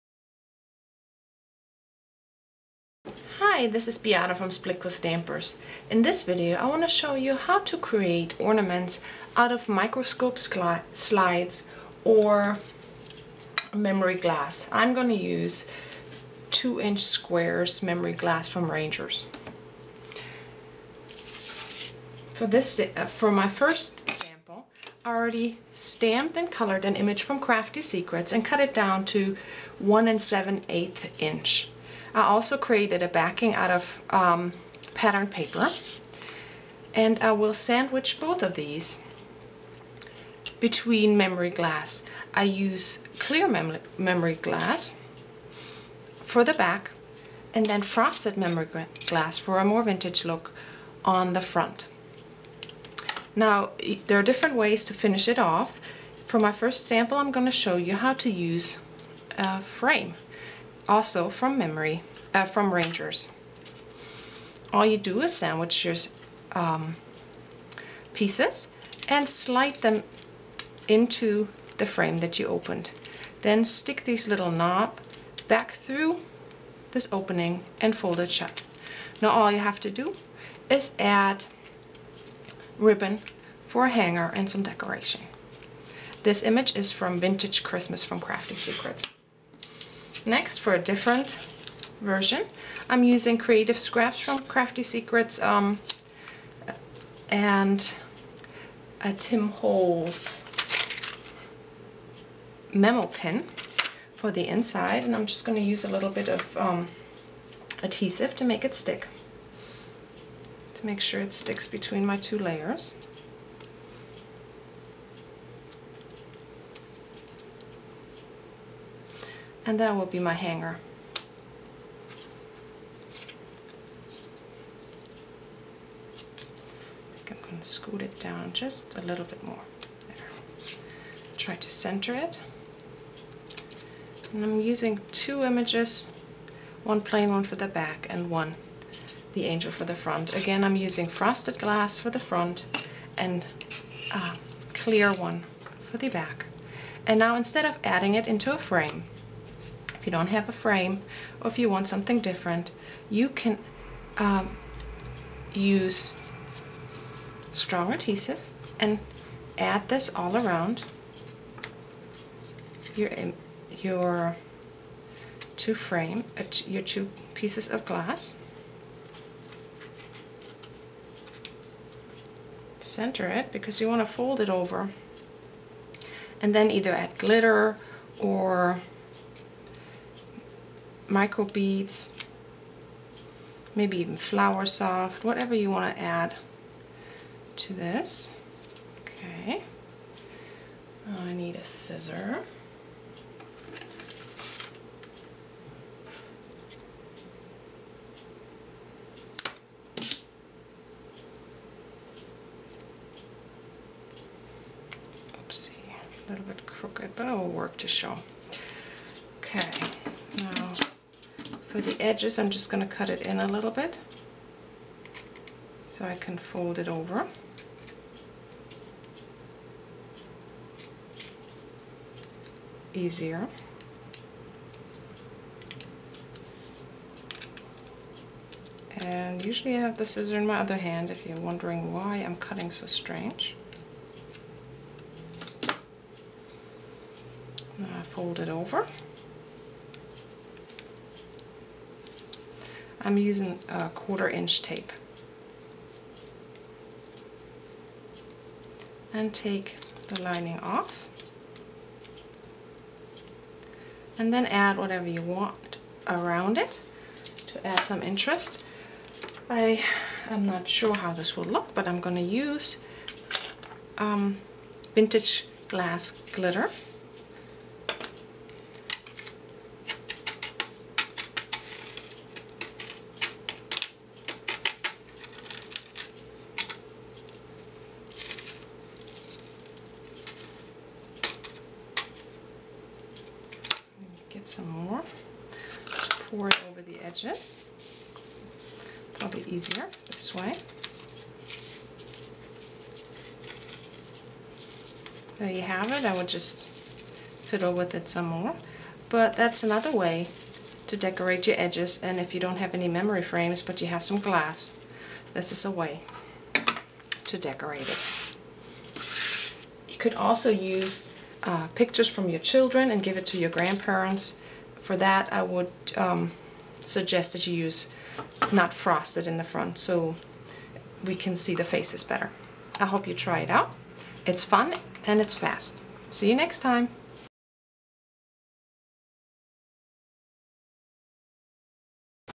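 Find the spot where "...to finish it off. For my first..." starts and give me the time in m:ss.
0:54.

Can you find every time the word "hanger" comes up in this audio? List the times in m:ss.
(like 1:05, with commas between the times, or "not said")
1:23, 2:00.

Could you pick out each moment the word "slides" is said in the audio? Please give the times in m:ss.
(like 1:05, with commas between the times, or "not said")
0:10, 1:09.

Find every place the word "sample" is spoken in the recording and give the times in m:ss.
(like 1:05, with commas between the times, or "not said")
0:24, 0:56.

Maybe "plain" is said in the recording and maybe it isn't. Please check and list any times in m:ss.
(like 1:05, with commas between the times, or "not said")
2:16.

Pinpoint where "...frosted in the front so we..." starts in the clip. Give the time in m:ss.
5:18.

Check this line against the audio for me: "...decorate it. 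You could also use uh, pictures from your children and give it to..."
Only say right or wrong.
right.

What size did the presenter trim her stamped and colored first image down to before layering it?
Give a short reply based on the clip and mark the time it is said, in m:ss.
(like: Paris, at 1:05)
1 7/8 inch, at 0:29.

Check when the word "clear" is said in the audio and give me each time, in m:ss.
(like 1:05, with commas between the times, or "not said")
0:43, 2:24.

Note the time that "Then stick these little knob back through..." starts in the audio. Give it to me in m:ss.
1:13.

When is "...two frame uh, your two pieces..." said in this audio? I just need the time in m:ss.
2:45.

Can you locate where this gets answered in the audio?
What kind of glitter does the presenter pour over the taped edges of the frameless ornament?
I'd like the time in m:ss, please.
4:24.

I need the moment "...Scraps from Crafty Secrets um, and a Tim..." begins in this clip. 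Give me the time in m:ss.
1:33.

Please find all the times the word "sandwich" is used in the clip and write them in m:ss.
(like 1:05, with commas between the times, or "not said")
0:37, 1:05.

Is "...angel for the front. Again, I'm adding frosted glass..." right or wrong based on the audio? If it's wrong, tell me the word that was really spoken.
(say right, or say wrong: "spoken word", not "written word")
wrong: "using", not "adding".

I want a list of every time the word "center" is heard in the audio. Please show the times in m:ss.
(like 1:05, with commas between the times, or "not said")
2:11, 2:52.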